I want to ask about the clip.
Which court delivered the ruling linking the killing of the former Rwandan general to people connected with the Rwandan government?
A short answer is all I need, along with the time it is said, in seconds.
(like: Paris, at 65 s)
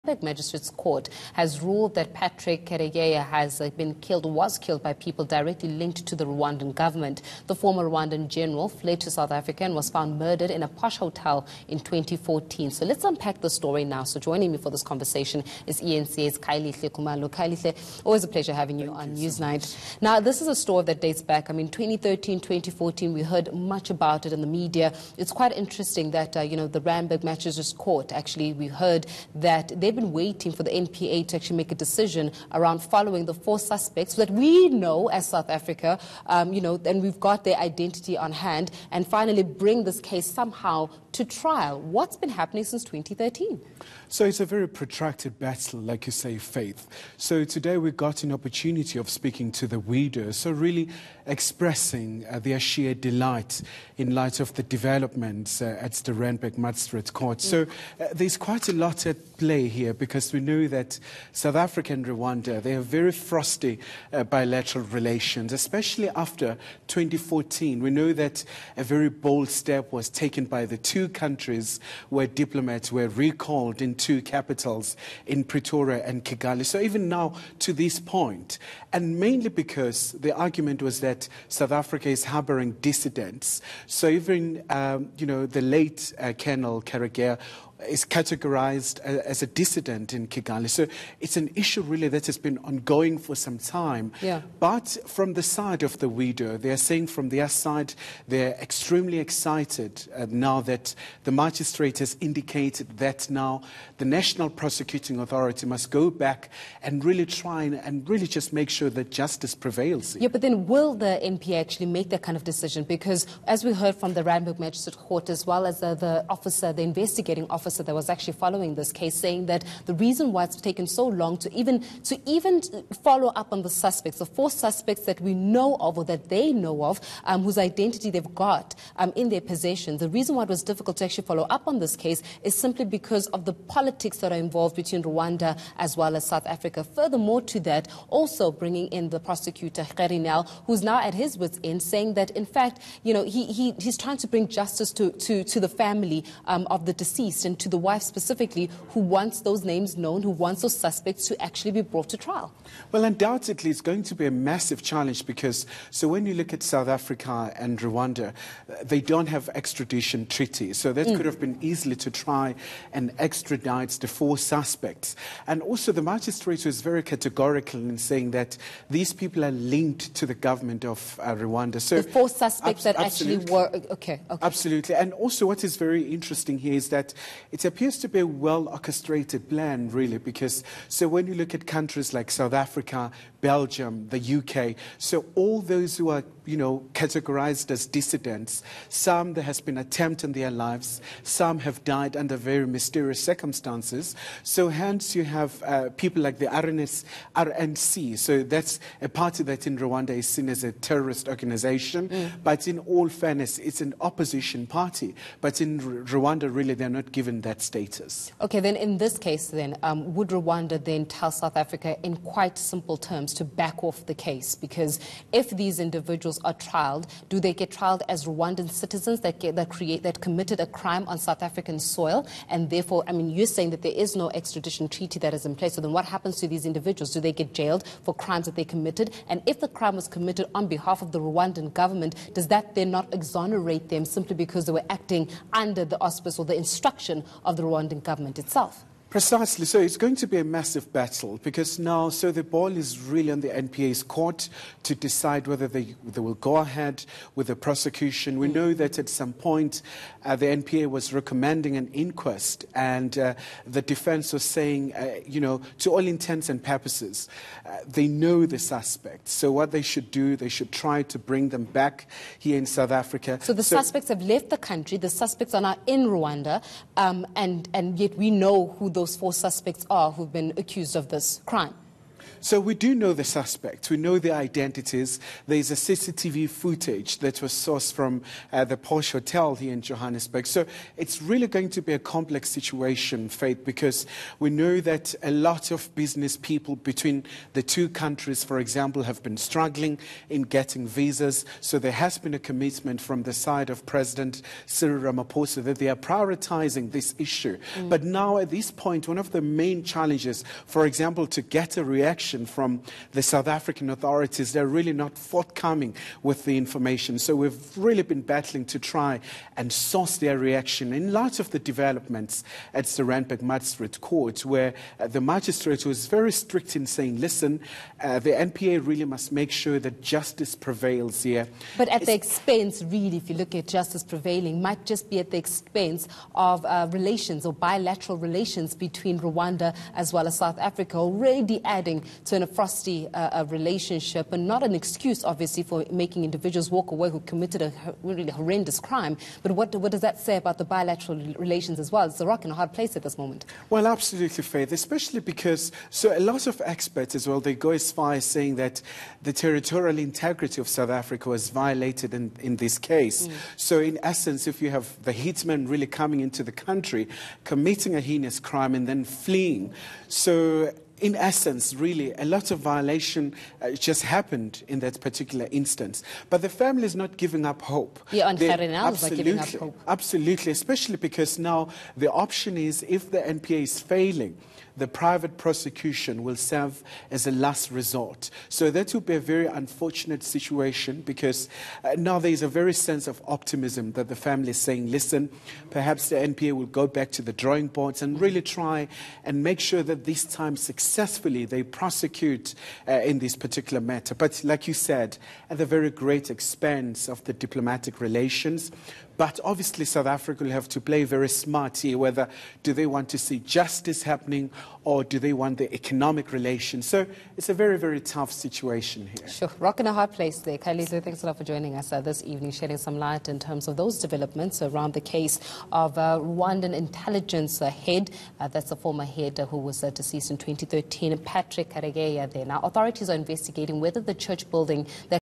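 Randburg Magistrates Court, at 26 s.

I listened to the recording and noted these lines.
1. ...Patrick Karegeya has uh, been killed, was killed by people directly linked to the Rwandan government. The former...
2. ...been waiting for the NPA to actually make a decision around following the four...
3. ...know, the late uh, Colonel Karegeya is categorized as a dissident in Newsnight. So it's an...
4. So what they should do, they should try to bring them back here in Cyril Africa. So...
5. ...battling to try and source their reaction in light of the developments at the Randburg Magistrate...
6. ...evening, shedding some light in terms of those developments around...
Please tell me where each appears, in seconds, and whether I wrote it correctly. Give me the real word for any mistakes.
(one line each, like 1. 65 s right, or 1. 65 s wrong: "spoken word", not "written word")
1. 2 s right
2. 30 s right
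3. 85 s wrong: "Kigali", not "Newsnight"
4. 259 s wrong: "South", not "Cyril"
5. 308 s right
6. 412 s right.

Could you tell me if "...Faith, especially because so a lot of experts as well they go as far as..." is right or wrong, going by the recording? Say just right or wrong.
right.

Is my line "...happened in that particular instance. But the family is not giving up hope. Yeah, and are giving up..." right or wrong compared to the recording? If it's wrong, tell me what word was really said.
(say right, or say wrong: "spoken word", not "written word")
right.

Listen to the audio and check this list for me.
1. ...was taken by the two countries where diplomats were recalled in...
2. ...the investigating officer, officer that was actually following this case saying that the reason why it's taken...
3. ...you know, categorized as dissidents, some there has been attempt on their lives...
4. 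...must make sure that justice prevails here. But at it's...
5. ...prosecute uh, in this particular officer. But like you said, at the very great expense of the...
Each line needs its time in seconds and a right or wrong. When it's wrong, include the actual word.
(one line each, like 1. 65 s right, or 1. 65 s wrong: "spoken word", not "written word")
1. 69 s right
2. 116 s right
3. 186 s right
4. 319 s right
5. 391 s wrong: "matter", not "officer".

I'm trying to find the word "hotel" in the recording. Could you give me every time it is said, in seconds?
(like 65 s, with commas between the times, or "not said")
10 s, 279 s.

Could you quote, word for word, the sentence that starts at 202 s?
but in all fairness, it's an opposition party.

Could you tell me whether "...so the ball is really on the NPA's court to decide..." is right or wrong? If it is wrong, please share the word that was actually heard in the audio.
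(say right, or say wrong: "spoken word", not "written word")
right.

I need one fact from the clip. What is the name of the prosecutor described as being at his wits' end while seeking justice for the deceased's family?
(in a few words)
Kherinal.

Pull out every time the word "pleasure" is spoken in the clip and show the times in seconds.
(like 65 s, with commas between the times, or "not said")
18 s.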